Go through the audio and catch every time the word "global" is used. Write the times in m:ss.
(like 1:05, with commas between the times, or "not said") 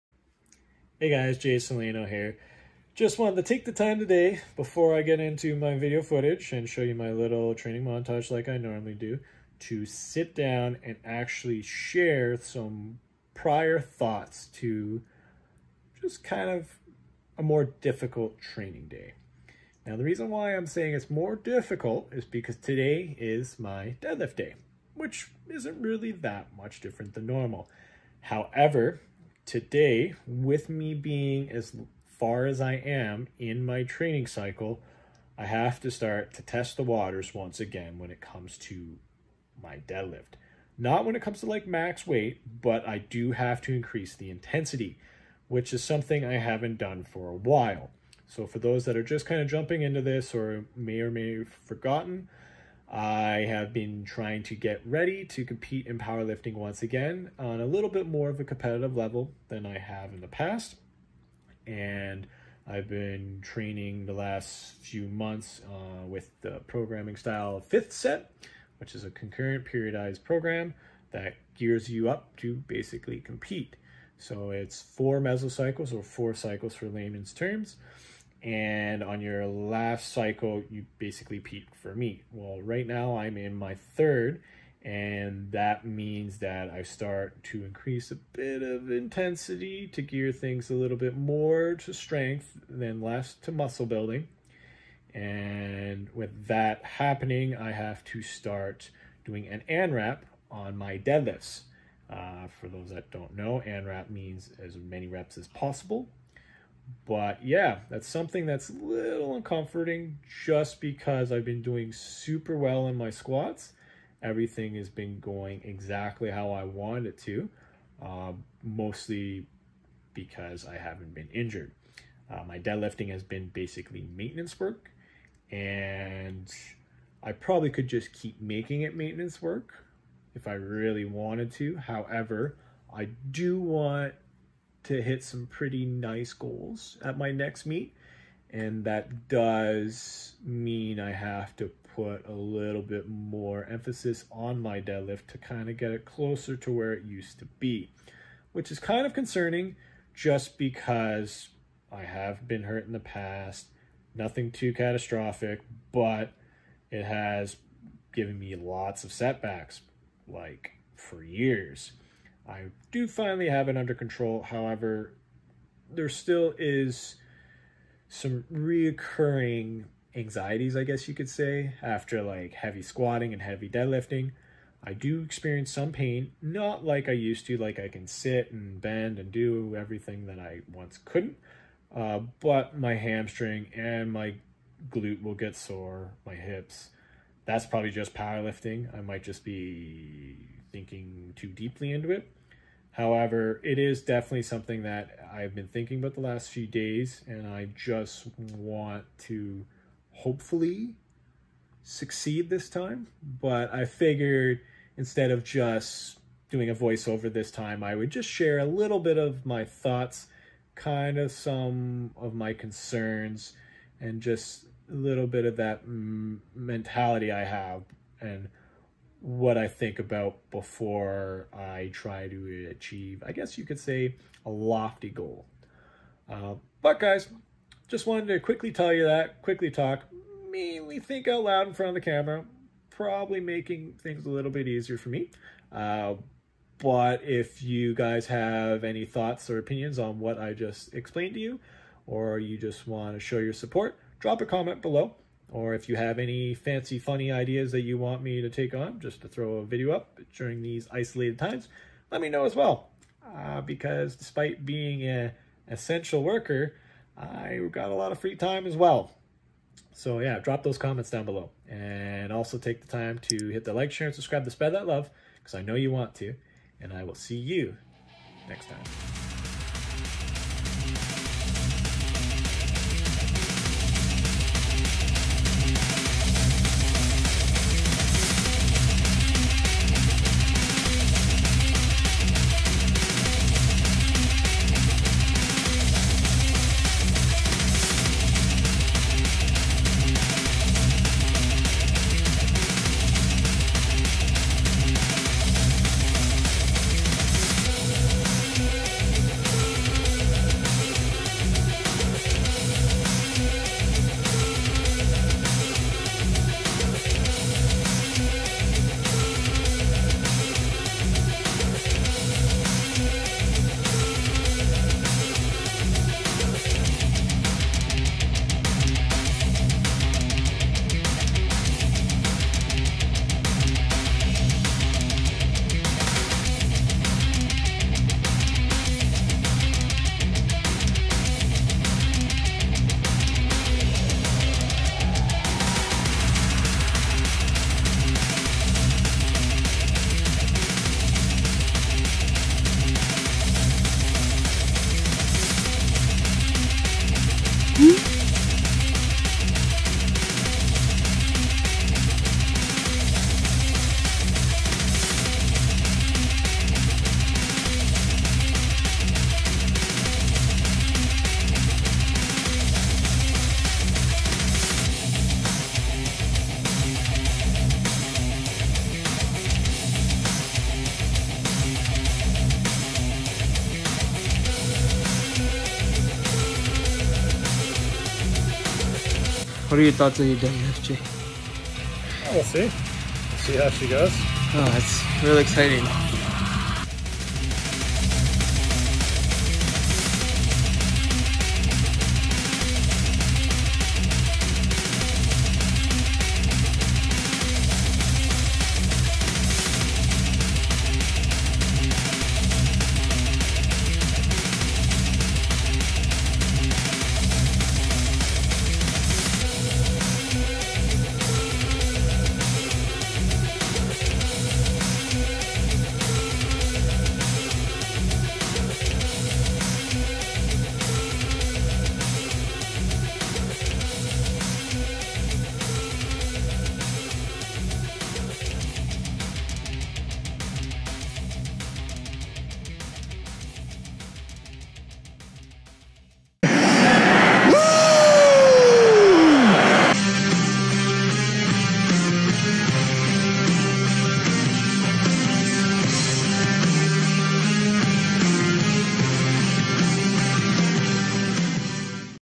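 not said.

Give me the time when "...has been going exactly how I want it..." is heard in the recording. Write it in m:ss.
1:54.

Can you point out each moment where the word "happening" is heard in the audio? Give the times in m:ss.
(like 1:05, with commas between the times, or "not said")
1:36.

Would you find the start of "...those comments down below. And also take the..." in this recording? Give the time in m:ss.
4:20.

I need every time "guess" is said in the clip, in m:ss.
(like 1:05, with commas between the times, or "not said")
2:50, 3:43.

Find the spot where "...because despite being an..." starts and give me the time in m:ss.
4:13.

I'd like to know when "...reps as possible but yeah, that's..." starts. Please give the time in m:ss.
1:45.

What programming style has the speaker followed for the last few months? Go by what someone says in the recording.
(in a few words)
Fifth set.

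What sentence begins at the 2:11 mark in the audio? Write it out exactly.
However, I do want to hit some pretty nice goals at my next meet.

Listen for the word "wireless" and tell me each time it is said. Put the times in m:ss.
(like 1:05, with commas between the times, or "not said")
not said.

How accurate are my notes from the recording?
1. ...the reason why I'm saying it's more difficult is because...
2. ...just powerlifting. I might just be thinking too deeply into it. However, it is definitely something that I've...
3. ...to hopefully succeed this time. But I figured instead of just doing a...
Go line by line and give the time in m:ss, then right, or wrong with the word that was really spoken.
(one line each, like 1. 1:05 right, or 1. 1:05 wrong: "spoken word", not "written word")
1. 0:19 right
2. 3:07 right
3. 3:19 right.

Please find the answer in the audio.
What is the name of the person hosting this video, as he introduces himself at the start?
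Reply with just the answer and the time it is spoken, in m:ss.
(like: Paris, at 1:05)
Jason Leeno, at 0:01.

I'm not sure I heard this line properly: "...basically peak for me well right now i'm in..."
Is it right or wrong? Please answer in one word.
right.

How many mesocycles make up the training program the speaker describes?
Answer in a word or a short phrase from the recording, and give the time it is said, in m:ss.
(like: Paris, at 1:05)
4, at 1:14.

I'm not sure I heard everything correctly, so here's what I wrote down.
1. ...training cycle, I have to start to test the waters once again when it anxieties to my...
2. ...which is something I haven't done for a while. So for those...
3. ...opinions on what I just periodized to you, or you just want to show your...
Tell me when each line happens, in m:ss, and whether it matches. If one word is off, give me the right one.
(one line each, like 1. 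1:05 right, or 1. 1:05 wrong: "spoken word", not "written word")
1. 0:33 wrong: "comes", not "anxieties"
2. 0:45 right
3. 3:59 wrong: "explained", not "periodized".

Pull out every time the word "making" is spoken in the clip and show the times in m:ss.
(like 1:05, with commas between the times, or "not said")
2:08, 3:53.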